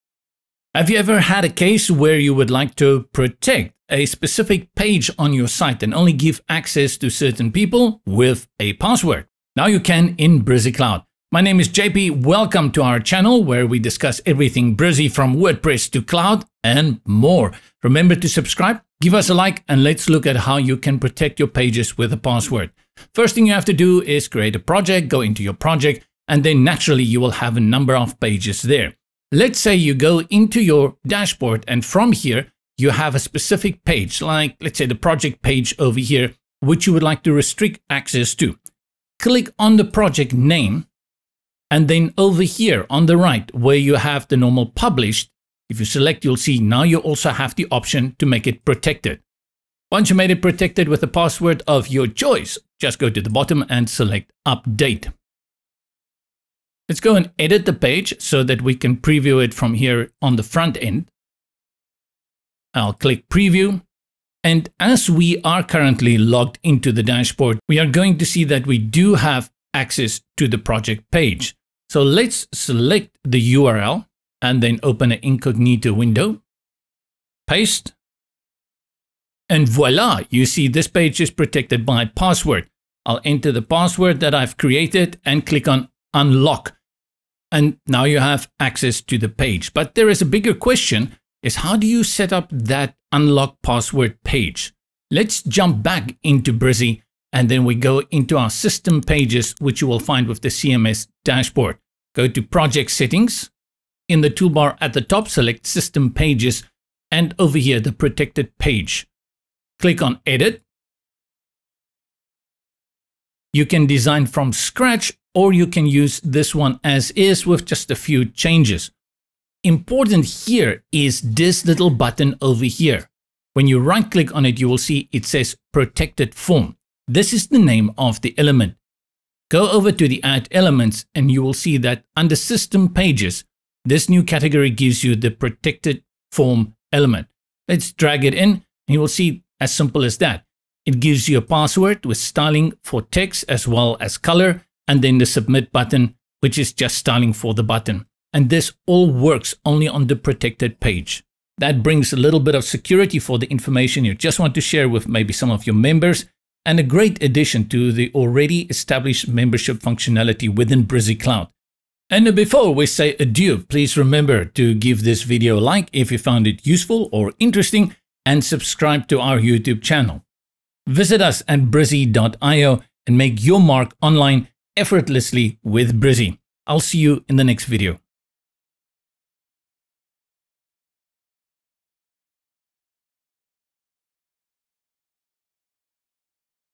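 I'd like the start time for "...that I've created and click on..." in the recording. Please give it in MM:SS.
01:24.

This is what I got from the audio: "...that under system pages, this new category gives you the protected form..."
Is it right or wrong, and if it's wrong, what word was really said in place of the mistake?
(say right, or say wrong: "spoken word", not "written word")
right.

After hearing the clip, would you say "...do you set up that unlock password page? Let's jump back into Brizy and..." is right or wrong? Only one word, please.
right.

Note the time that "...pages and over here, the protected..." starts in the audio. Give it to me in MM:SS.
01:46.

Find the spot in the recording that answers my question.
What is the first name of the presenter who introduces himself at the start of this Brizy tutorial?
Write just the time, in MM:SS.
00:11.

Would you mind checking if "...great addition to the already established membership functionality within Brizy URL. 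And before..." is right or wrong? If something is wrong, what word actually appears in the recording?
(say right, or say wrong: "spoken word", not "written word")
wrong: "Cloud", not "URL".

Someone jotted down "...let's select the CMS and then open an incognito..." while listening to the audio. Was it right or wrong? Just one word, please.
wrong.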